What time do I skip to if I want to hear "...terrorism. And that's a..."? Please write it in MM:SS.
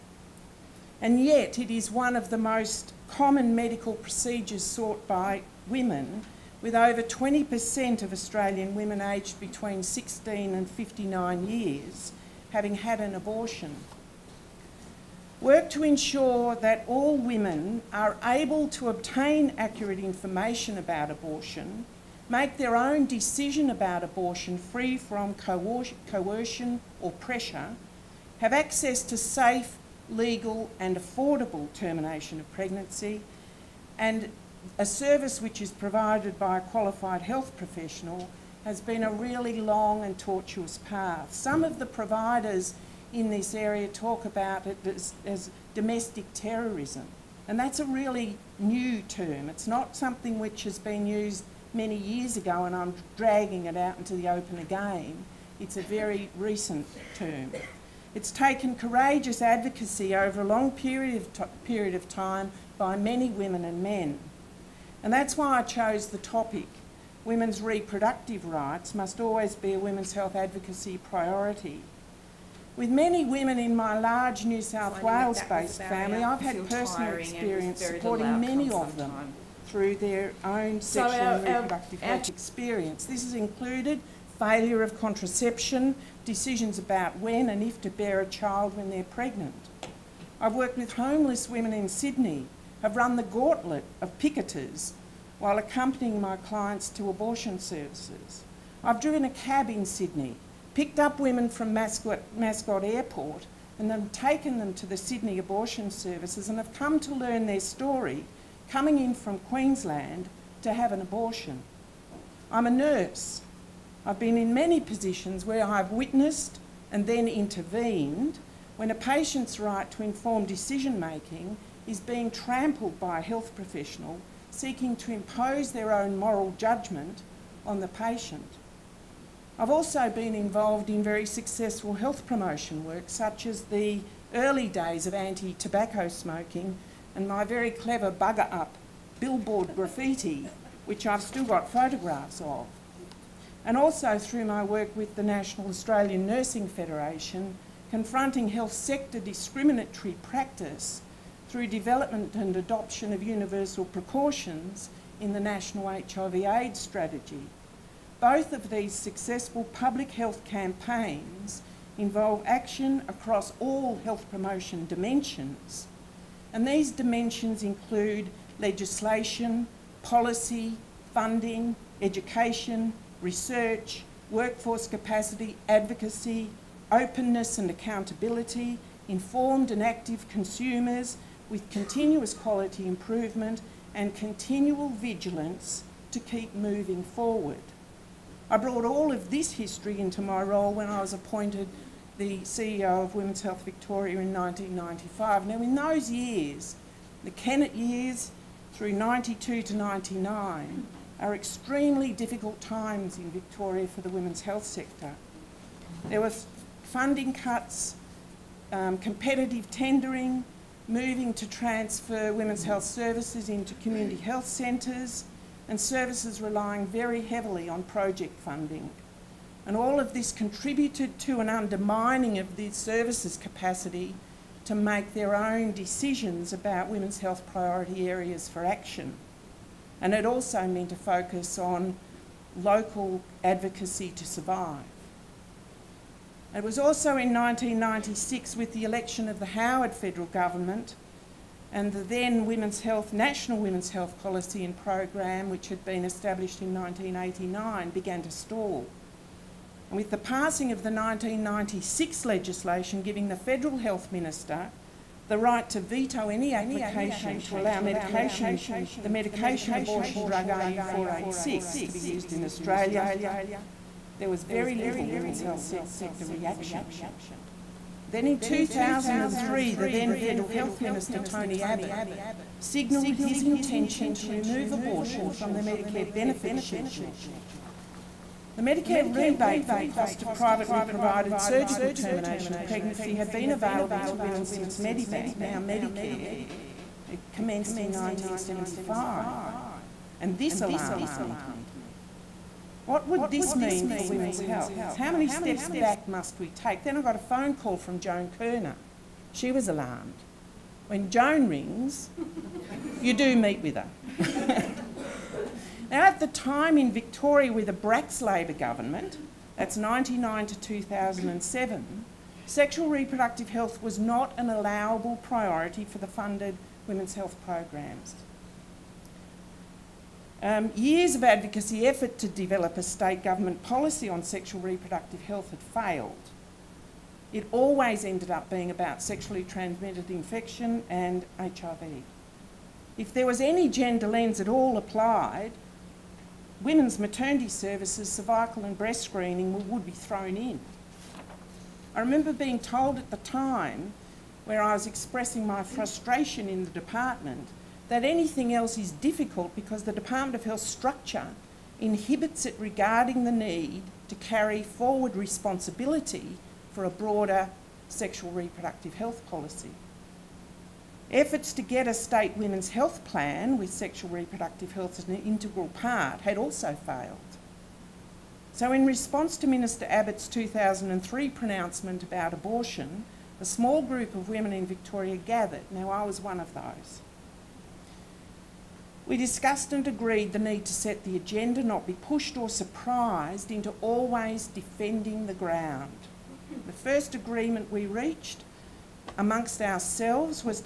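00:46.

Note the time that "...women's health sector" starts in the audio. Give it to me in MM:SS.
03:24.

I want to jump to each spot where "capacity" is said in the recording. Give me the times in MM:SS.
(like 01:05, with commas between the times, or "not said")
02:54, 03:43.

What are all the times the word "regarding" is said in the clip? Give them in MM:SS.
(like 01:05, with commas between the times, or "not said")
05:52.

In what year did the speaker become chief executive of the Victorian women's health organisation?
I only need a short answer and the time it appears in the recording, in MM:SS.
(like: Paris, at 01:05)
1995, at 03:14.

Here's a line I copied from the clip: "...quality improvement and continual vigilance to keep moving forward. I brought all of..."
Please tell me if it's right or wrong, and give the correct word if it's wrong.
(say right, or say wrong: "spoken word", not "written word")
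right.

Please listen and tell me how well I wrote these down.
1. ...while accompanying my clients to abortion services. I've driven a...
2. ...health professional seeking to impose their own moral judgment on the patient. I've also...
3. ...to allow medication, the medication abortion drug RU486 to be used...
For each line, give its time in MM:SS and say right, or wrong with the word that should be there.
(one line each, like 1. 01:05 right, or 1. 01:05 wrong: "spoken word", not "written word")
1. 01:35 right
2. 02:03 right
3. 04:17 right.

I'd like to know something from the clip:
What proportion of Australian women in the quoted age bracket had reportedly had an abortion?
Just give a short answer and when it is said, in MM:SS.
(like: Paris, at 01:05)
over 20%, at 00:06.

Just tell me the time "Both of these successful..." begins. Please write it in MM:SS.
02:38.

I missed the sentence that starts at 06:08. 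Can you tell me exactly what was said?
So in response to Minister Abbott's 2003 pronouncement about abortion, a small group of women in Victoria gathered.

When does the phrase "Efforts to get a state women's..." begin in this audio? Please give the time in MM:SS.
06:01.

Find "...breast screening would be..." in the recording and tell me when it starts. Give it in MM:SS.
05:38.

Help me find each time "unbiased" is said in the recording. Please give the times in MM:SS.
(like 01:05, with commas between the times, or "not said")
not said.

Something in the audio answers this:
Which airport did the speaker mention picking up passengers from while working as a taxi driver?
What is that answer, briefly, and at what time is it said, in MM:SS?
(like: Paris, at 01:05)
Mascot Airport, at 01:42.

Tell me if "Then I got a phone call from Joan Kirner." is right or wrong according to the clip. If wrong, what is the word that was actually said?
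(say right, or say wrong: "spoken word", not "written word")
right.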